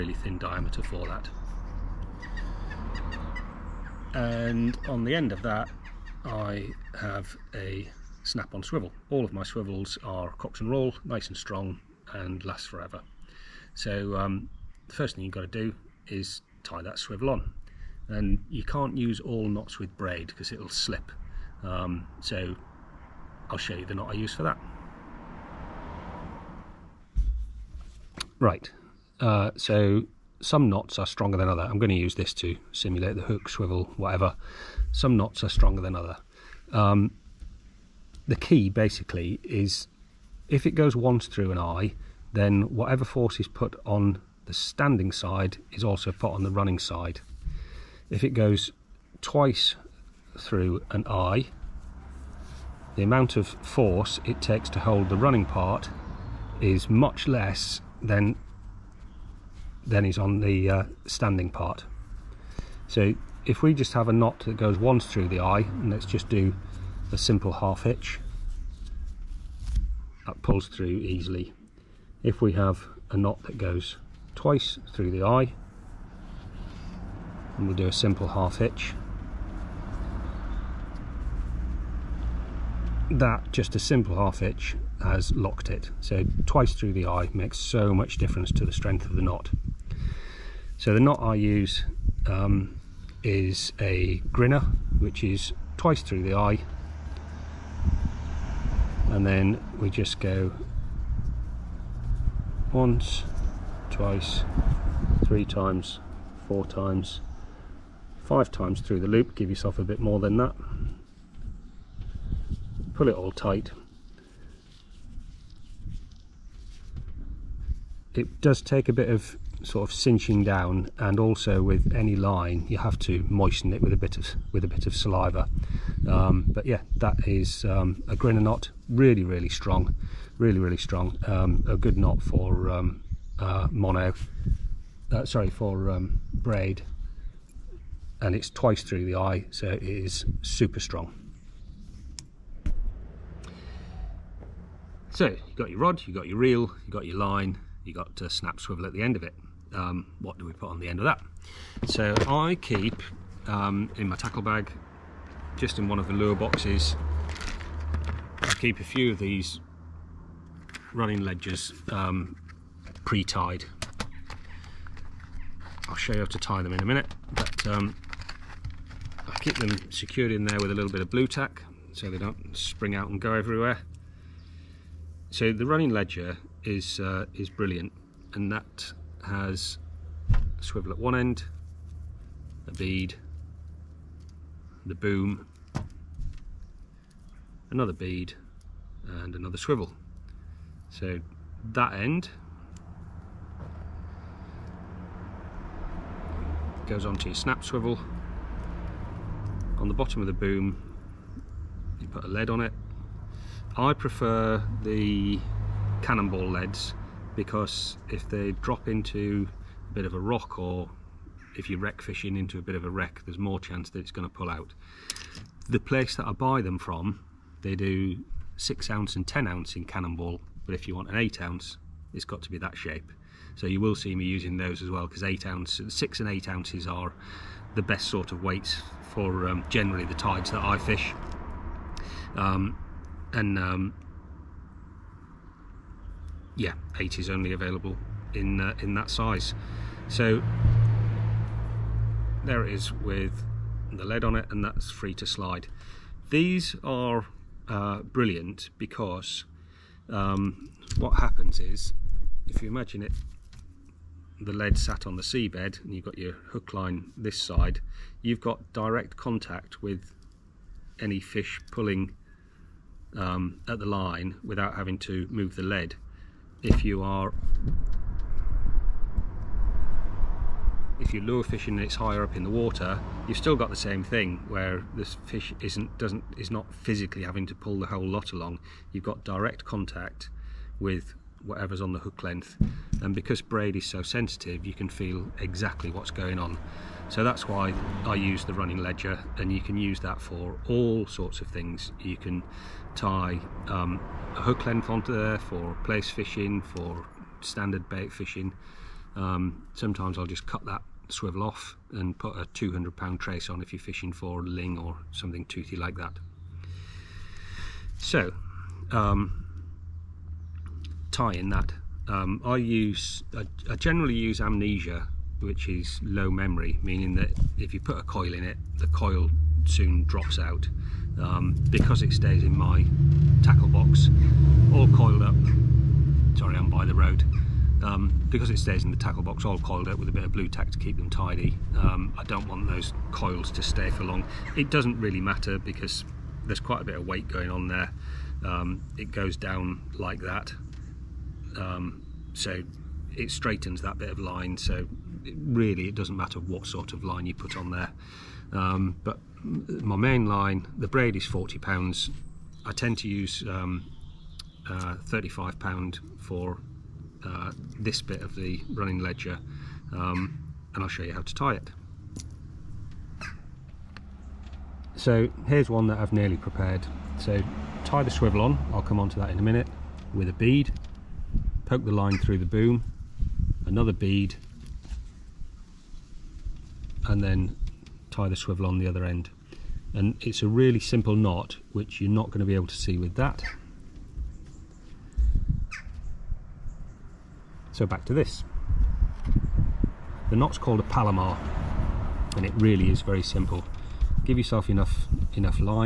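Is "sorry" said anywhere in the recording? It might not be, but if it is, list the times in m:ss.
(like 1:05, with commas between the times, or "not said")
2:15, 5:26.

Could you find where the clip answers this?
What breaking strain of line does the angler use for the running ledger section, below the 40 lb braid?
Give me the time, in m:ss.
5:55.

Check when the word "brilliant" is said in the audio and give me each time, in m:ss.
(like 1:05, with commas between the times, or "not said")
2:57, 4:08.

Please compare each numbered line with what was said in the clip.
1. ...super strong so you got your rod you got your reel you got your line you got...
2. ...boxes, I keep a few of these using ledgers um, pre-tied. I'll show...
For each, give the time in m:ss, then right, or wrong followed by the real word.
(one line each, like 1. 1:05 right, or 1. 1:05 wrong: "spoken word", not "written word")
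1. 2:20 right
2. 2:36 wrong: "running", not "using".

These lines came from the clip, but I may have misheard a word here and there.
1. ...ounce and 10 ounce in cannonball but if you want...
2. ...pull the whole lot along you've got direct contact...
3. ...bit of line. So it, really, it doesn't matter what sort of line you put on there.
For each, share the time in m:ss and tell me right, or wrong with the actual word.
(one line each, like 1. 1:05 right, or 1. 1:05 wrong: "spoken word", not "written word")
1. 3:38 right
2. 4:37 right
3. 5:43 right.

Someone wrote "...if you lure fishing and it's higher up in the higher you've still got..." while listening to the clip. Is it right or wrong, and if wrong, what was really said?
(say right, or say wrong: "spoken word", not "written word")
wrong: "water", not "higher".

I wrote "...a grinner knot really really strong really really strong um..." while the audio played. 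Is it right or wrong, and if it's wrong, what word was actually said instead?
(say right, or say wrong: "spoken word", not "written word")
right.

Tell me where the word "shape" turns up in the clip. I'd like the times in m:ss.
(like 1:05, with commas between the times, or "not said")
3:42.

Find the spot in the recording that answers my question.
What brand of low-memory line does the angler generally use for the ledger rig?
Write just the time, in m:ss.
5:14.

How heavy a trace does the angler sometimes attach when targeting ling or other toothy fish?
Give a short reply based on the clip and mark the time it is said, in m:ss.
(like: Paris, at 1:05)
200 pound, at 5:02.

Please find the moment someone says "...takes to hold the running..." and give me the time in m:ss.
0:54.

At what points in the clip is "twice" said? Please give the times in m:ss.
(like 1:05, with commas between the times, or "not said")
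0:49, 1:14, 1:26, 1:35, 1:43, 2:18.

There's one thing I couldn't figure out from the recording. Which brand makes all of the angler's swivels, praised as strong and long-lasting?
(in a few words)
Cox and Rawle.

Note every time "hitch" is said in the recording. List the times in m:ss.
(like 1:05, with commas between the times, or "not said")
1:07, 1:18, 1:24.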